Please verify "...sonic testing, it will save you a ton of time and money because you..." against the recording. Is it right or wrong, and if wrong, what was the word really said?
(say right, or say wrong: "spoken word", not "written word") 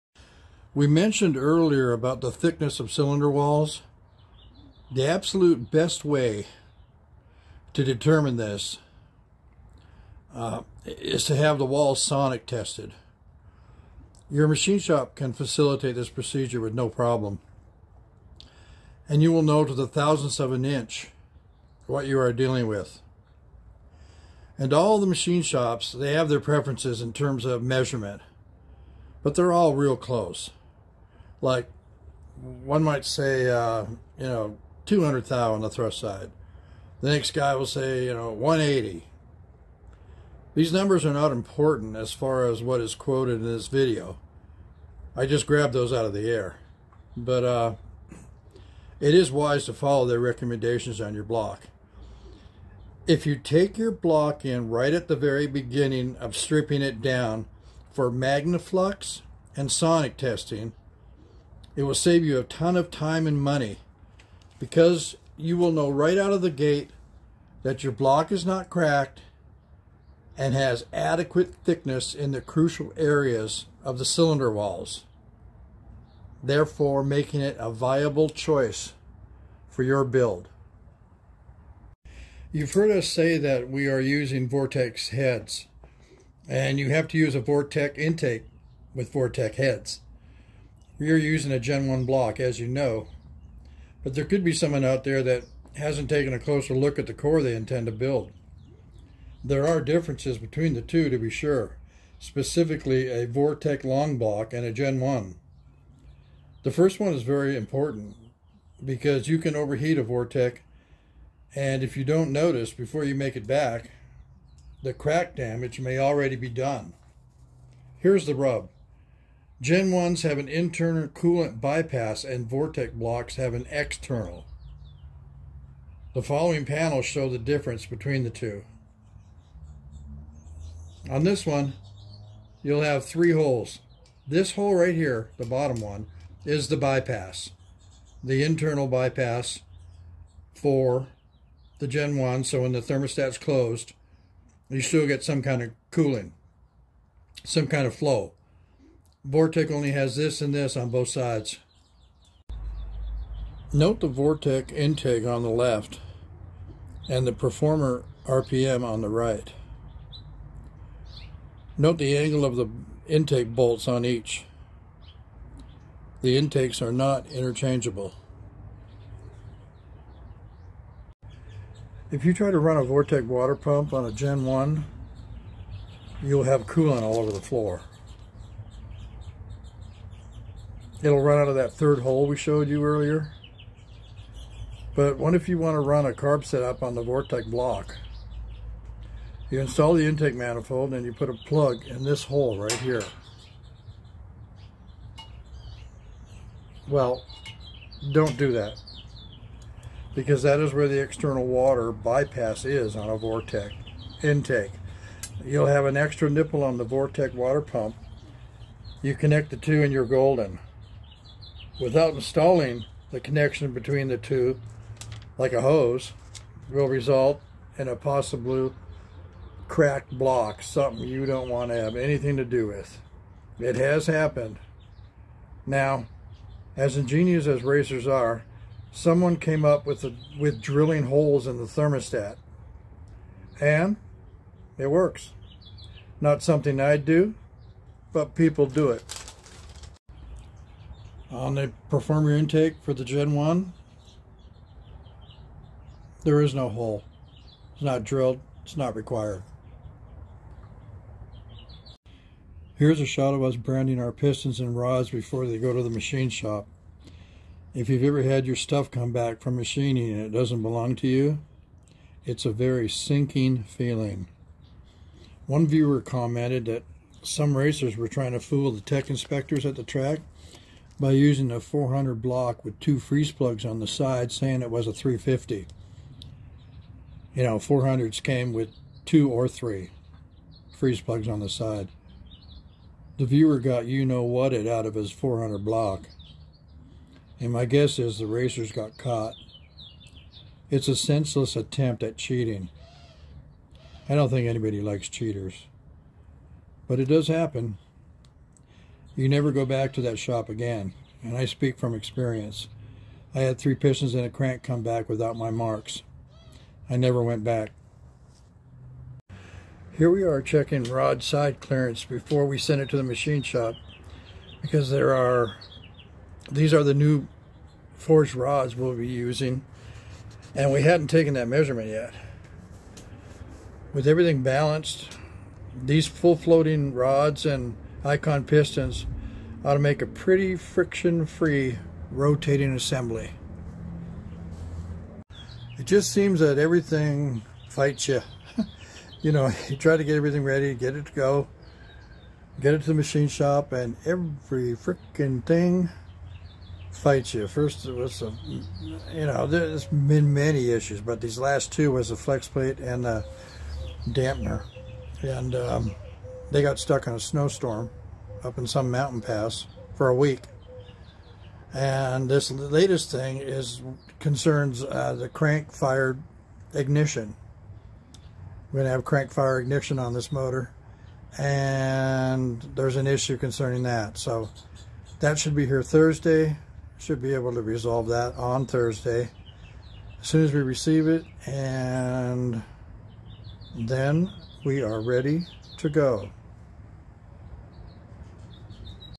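right.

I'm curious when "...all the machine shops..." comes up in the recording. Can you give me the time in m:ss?
0:24.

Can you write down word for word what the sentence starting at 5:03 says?
I had three pistons and a crank come back without my marks.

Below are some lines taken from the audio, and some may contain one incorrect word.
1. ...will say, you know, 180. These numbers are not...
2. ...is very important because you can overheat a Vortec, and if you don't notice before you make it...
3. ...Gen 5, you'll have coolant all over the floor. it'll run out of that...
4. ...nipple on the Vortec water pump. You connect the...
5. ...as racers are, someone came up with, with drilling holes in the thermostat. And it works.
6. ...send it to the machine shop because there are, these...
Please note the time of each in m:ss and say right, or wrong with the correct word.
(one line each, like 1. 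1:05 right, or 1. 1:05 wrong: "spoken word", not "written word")
1. 0:37 right
2. 1:47 right
3. 2:54 wrong: "1", not "5"
4. 3:26 right
5. 3:47 right
6. 5:12 right.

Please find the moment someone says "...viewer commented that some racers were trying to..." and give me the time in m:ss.
4:25.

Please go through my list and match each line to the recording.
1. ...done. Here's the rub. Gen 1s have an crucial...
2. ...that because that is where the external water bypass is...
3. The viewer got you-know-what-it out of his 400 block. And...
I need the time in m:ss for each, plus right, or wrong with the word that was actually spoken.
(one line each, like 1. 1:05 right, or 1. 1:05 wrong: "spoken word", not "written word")
1. 1:56 wrong: "internal", not "crucial"
2. 3:18 right
3. 4:43 right.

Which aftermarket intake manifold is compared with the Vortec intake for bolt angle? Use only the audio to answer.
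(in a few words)
Performer RPM.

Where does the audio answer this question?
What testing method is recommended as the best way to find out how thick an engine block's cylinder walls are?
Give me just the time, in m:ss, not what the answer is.
0:12.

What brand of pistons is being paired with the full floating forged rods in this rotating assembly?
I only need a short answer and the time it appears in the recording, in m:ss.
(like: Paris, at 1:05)
Icon, at 5:28.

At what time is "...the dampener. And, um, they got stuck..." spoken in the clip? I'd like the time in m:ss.
5:53.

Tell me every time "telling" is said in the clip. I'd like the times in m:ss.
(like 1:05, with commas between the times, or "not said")
not said.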